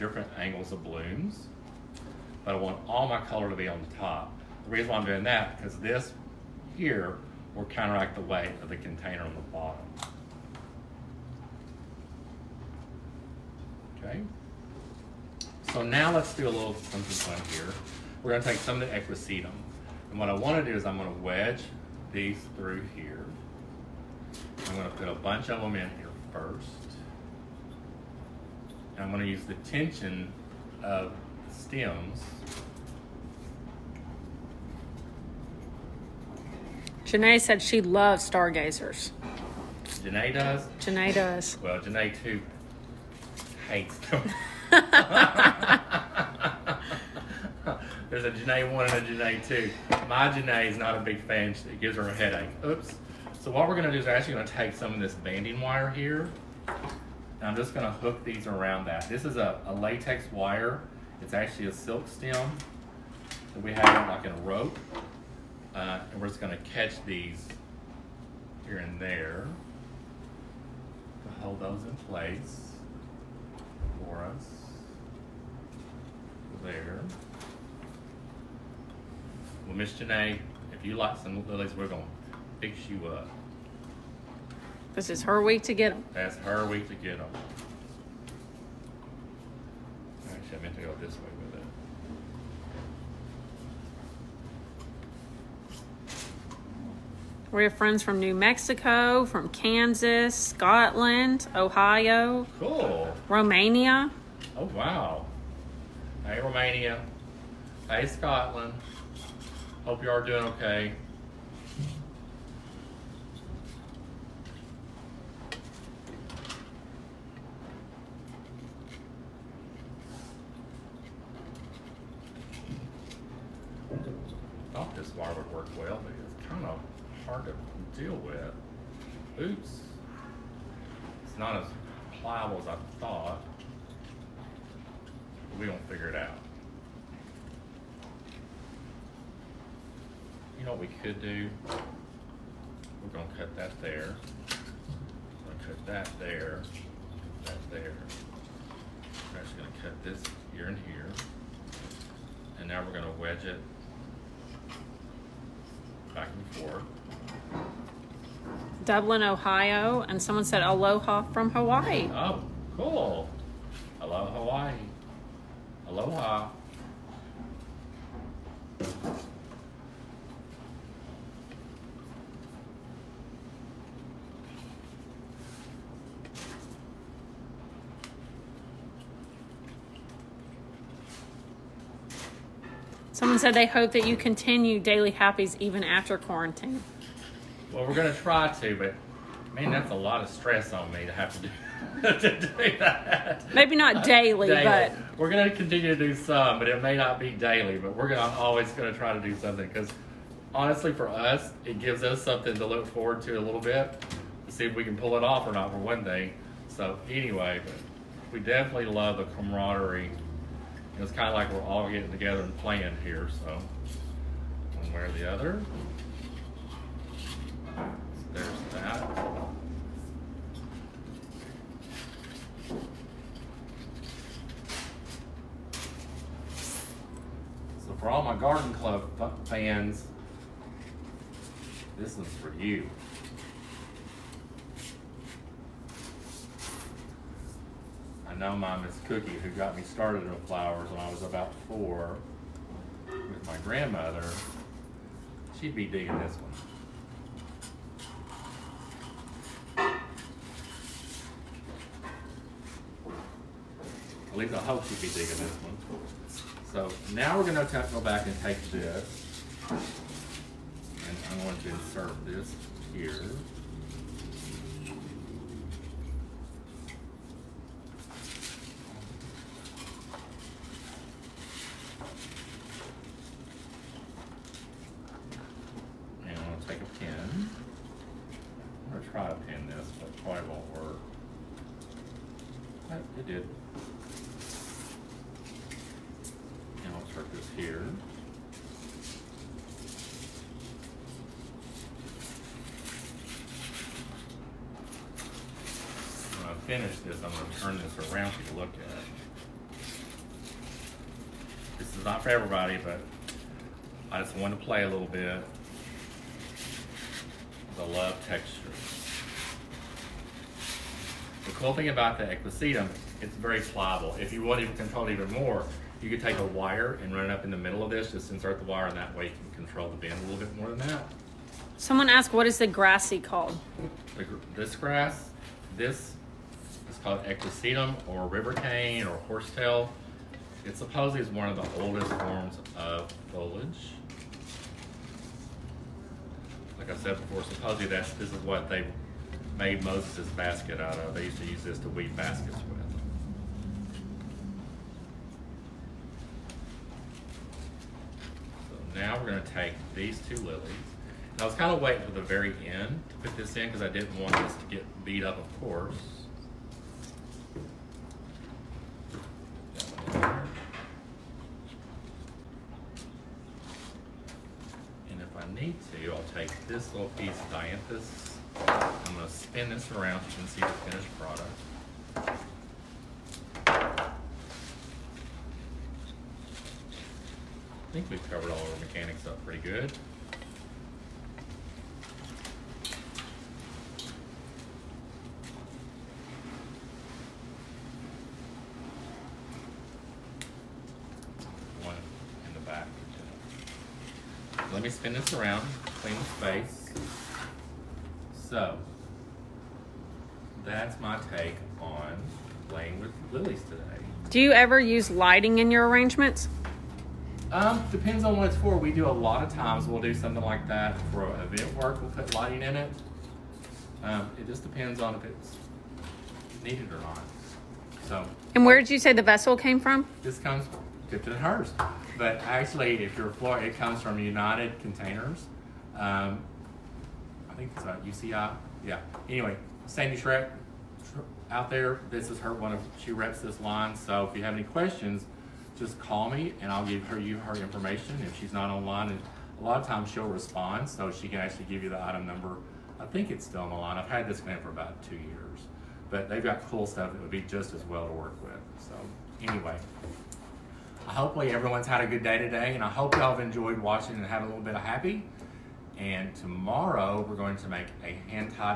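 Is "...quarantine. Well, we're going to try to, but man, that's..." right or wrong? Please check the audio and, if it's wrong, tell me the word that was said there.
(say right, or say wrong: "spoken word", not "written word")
right.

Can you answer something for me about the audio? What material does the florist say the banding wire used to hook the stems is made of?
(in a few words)
latex.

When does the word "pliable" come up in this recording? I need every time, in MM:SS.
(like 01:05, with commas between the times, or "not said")
02:12, 05:13.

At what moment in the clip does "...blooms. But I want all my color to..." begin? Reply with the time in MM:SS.
00:00.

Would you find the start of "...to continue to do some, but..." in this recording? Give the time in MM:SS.
03:15.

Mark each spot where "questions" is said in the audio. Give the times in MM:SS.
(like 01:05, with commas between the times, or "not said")
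07:14.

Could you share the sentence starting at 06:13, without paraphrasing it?
I think we've covered all our mechanics up pretty good.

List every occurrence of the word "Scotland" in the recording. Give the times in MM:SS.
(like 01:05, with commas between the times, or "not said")
01:40, 01:48.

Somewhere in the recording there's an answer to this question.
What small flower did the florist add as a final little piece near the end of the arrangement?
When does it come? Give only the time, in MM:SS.
06:07.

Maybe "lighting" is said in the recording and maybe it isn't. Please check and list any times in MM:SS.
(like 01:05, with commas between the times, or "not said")
06:45, 06:52.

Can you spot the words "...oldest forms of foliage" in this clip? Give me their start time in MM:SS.
05:31.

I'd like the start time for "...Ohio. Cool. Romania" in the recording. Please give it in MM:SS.
01:41.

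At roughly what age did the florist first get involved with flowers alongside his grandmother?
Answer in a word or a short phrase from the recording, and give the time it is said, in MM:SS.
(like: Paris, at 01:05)
4, at 04:01.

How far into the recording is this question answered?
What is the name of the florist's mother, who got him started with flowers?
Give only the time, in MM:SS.
03:59.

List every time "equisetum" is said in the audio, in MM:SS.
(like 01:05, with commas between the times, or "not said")
00:18, 05:12, 05:27.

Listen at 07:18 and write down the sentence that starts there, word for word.
If she's not online, and a lot of times she'll respond, so she can actually give you the item number.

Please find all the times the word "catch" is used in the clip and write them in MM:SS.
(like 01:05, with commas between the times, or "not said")
01:06.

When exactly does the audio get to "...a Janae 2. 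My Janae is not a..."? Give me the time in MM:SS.
00:48.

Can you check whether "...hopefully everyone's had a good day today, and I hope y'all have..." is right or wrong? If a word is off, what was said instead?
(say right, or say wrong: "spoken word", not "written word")
right.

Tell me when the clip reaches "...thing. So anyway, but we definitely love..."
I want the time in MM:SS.
03:26.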